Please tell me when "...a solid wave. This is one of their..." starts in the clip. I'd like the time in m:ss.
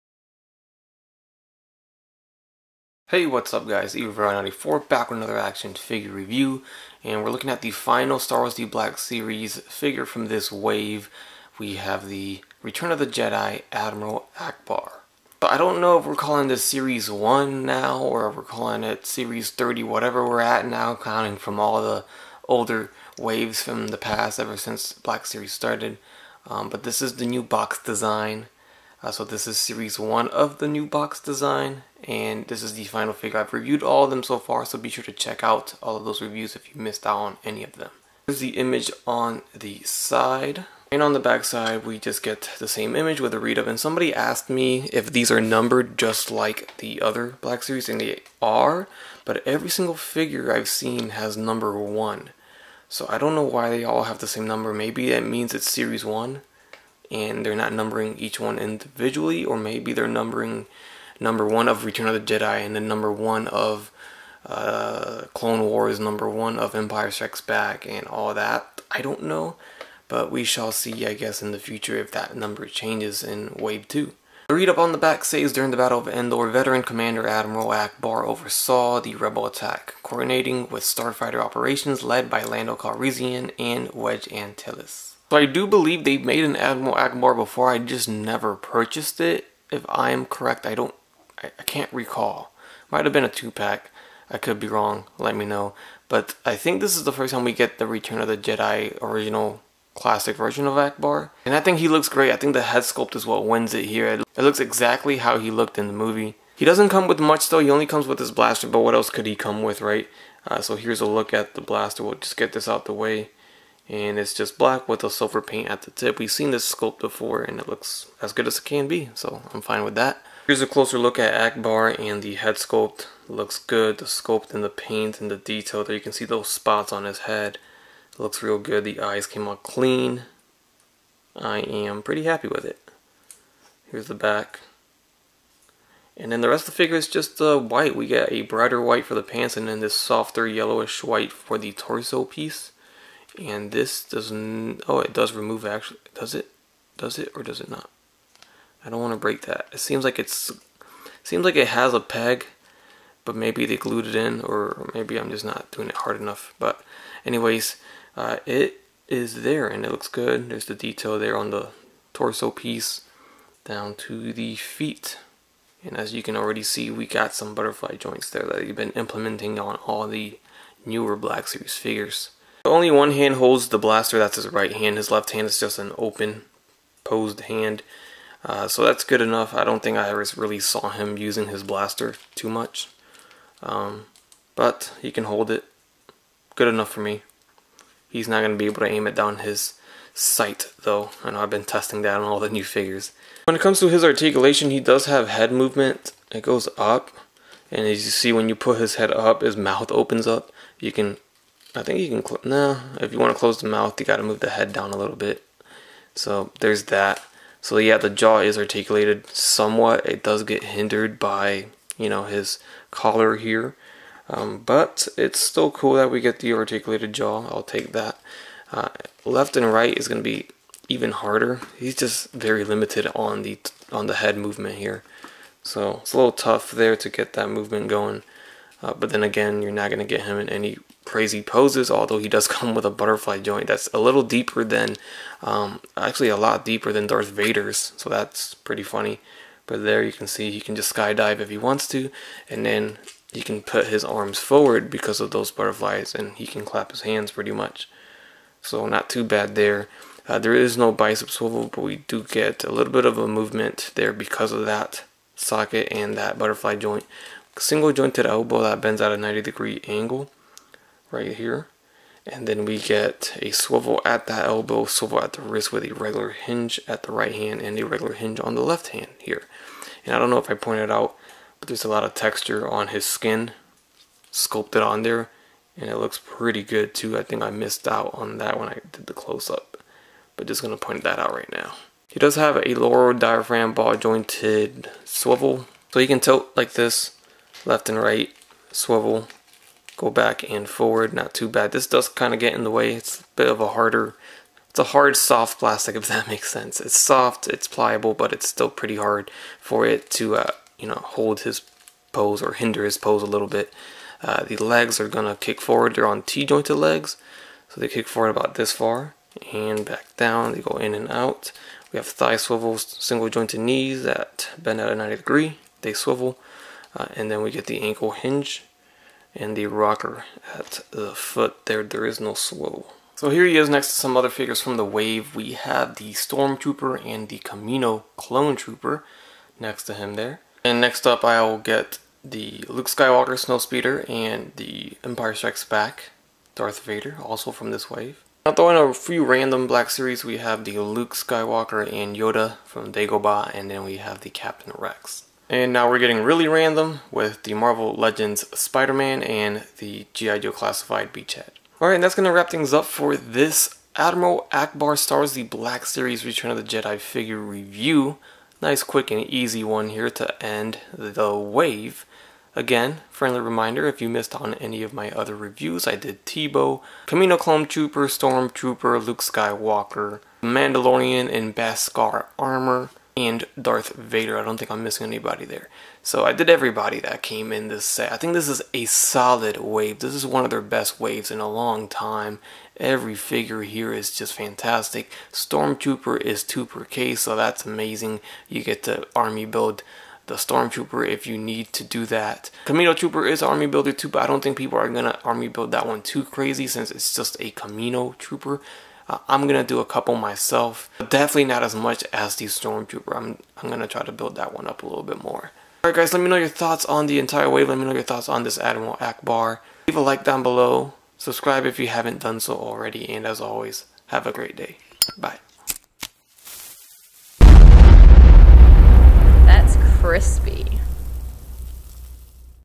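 6:18.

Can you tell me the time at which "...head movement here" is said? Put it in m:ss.
3:44.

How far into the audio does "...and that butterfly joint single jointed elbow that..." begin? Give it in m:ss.
4:15.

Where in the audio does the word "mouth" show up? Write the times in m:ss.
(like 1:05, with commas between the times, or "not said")
3:19, 3:23.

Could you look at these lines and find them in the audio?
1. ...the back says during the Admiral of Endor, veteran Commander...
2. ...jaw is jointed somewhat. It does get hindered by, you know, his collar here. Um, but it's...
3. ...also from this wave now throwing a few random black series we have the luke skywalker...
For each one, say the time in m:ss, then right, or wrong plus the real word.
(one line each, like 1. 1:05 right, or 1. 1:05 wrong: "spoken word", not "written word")
1. 1:14 wrong: "Battle", not "Admiral"
2. 3:28 wrong: "articulated", not "jointed"
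3. 5:37 right.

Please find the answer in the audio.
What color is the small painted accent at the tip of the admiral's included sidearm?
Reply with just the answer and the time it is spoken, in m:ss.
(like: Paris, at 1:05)
Silver, at 1:55.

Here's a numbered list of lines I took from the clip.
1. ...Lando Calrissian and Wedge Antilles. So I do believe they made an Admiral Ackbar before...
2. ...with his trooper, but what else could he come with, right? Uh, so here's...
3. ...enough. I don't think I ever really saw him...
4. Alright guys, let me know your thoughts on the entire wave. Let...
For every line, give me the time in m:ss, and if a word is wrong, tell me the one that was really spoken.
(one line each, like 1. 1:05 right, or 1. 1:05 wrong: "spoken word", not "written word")
1. 1:22 right
2. 1:48 wrong: "blaster", not "trooper"
3. 2:59 right
4. 6:45 right.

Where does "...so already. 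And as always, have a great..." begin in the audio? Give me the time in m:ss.
6:52.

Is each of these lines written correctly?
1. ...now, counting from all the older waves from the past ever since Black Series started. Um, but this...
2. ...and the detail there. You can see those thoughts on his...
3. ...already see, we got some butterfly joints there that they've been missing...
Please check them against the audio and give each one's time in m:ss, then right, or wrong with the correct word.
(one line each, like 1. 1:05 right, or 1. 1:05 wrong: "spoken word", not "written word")
1. 0:20 right
2. 2:05 wrong: "spots", not "thoughts"
3. 2:46 wrong: "implementing", not "missing".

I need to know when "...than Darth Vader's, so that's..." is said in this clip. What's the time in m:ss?
3:56.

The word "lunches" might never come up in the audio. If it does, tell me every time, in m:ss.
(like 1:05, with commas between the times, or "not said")
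not said.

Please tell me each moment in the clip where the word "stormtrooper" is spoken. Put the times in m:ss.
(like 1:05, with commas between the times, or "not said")
5:26, 6:08, 6:25, 6:30, 6:42.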